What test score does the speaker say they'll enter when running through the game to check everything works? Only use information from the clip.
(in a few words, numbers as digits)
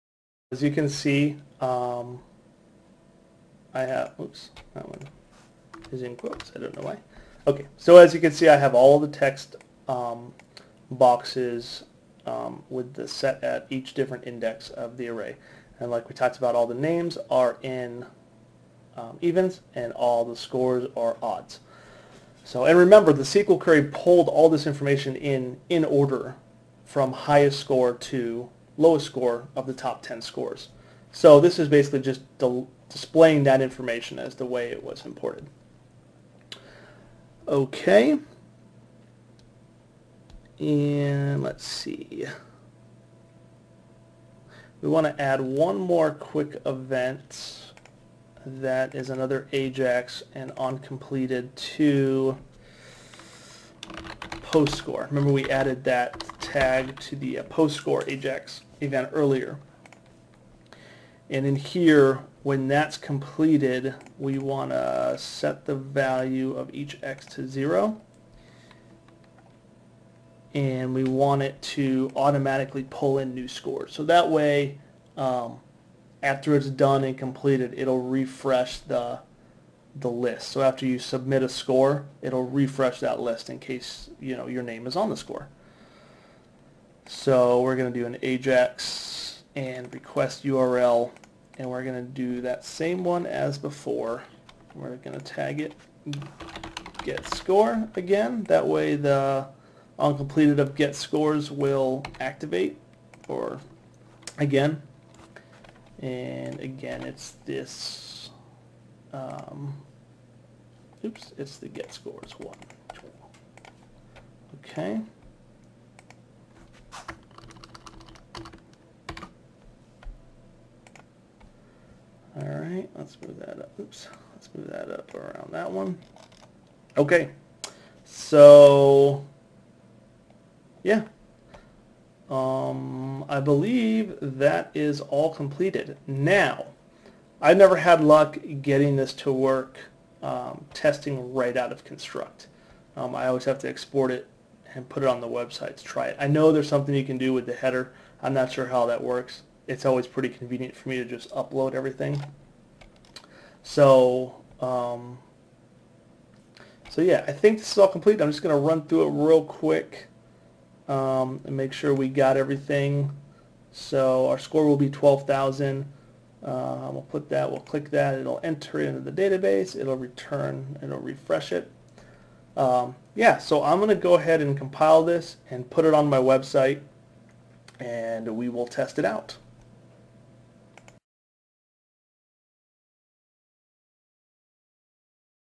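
12,000.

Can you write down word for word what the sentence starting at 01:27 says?
So we're going to do an AJAX and request URL and we're going to do that same one as before.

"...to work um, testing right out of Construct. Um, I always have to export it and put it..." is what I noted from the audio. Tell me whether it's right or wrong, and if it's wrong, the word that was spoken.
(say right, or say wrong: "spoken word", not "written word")
right.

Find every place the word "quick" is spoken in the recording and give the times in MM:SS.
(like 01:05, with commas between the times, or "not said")
00:46, 02:39.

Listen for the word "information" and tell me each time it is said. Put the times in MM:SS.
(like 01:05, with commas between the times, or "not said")
00:24, 00:33.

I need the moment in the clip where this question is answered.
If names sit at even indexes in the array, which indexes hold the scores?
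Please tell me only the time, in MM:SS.
00:21.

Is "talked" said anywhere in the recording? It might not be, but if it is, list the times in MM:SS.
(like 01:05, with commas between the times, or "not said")
00:16.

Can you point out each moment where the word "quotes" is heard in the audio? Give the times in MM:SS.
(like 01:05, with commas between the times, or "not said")
00:06.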